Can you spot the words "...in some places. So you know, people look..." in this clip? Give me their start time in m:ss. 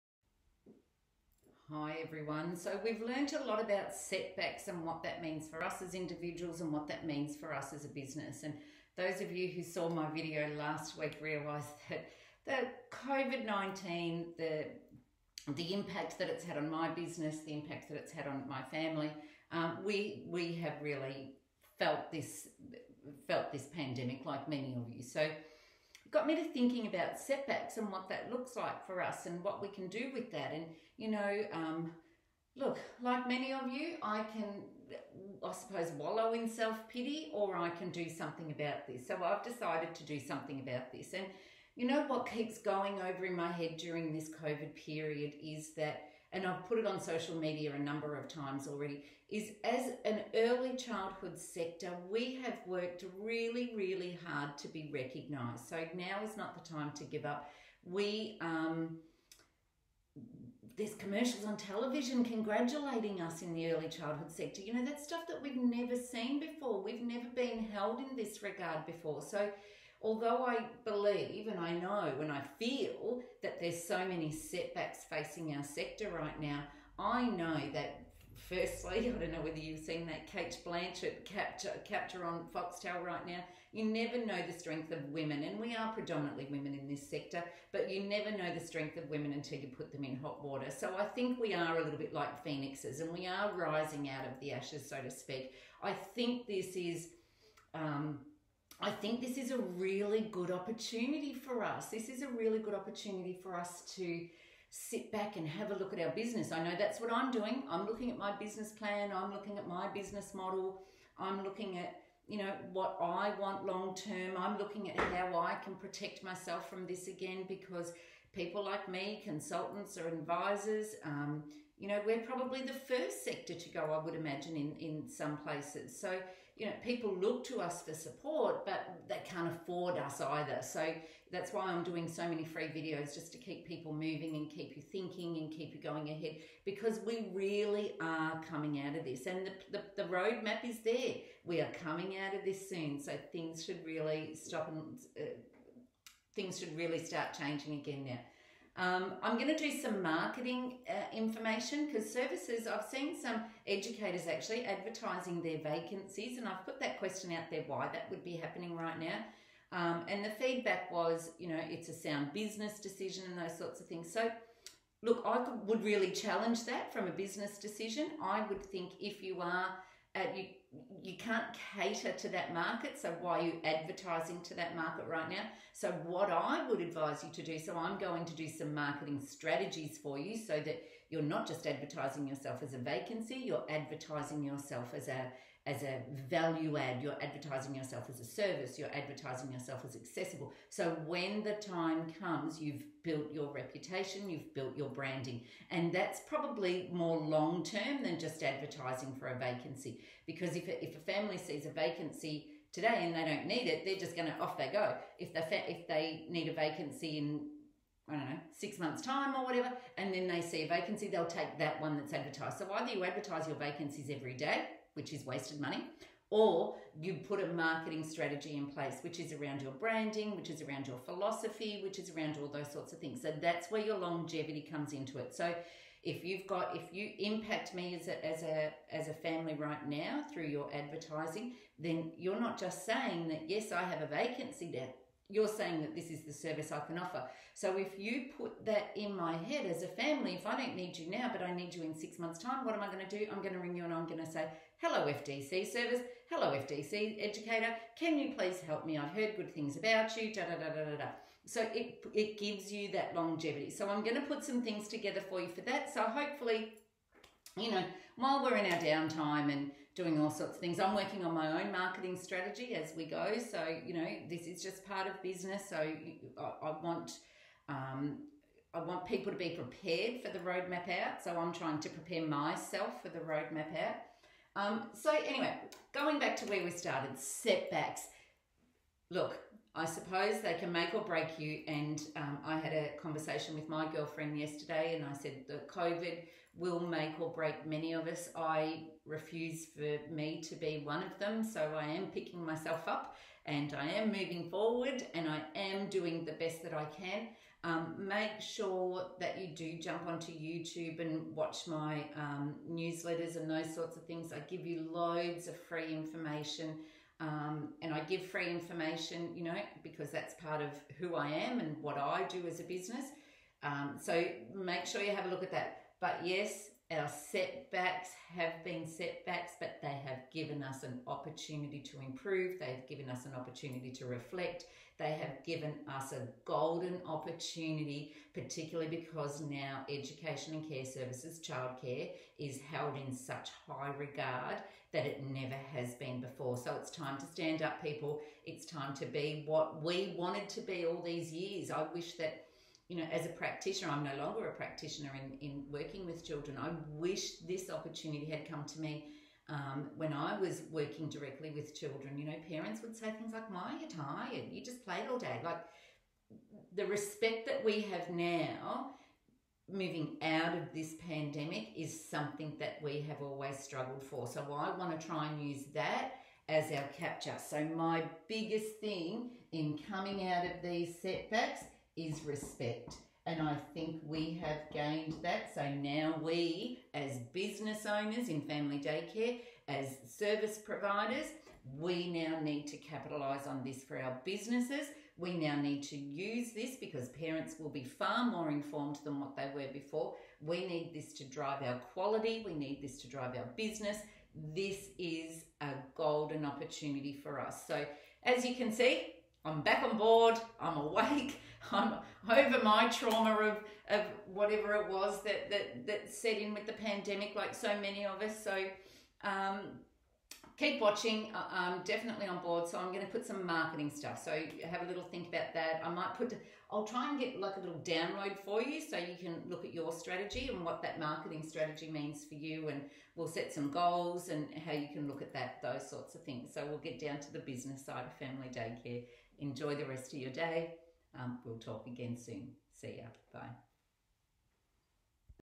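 2:04.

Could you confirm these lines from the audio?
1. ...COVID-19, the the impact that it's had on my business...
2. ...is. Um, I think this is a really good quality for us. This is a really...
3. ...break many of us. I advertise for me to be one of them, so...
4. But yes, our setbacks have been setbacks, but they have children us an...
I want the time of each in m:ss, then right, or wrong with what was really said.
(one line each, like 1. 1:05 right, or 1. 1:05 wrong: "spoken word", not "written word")
1. 0:13 right
2. 1:36 wrong: "opportunity", not "quality"
3. 4:47 wrong: "refuse", not "advertise"
4. 5:15 wrong: "given", not "children".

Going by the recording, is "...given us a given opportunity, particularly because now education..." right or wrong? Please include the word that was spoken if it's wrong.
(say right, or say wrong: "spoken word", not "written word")
wrong: "golden", not "given".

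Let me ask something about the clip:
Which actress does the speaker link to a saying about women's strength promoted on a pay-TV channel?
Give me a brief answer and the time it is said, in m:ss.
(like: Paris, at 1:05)
Cate Blanchett, at 1:20.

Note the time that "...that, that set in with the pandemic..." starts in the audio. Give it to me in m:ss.
6:45.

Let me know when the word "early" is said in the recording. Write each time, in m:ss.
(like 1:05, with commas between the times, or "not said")
0:50, 1:03.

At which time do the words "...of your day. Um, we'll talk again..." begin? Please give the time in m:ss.
7:10.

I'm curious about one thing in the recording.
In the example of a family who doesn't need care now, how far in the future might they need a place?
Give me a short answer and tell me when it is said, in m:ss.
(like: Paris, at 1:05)
6 months, at 3:28.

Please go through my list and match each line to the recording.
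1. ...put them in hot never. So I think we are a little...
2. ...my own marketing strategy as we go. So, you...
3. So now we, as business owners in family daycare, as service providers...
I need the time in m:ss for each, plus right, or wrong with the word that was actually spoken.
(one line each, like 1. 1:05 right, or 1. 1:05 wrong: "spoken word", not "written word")
1. 1:29 wrong: "water", not "never"
2. 4:21 right
3. 6:15 right.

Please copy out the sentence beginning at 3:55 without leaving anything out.
You're saying that this is the service I can offer.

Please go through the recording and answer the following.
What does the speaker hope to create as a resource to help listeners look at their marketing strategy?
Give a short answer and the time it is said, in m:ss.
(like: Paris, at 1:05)
a little download, at 6:57.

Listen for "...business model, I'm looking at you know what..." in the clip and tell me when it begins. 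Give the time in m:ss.
1:49.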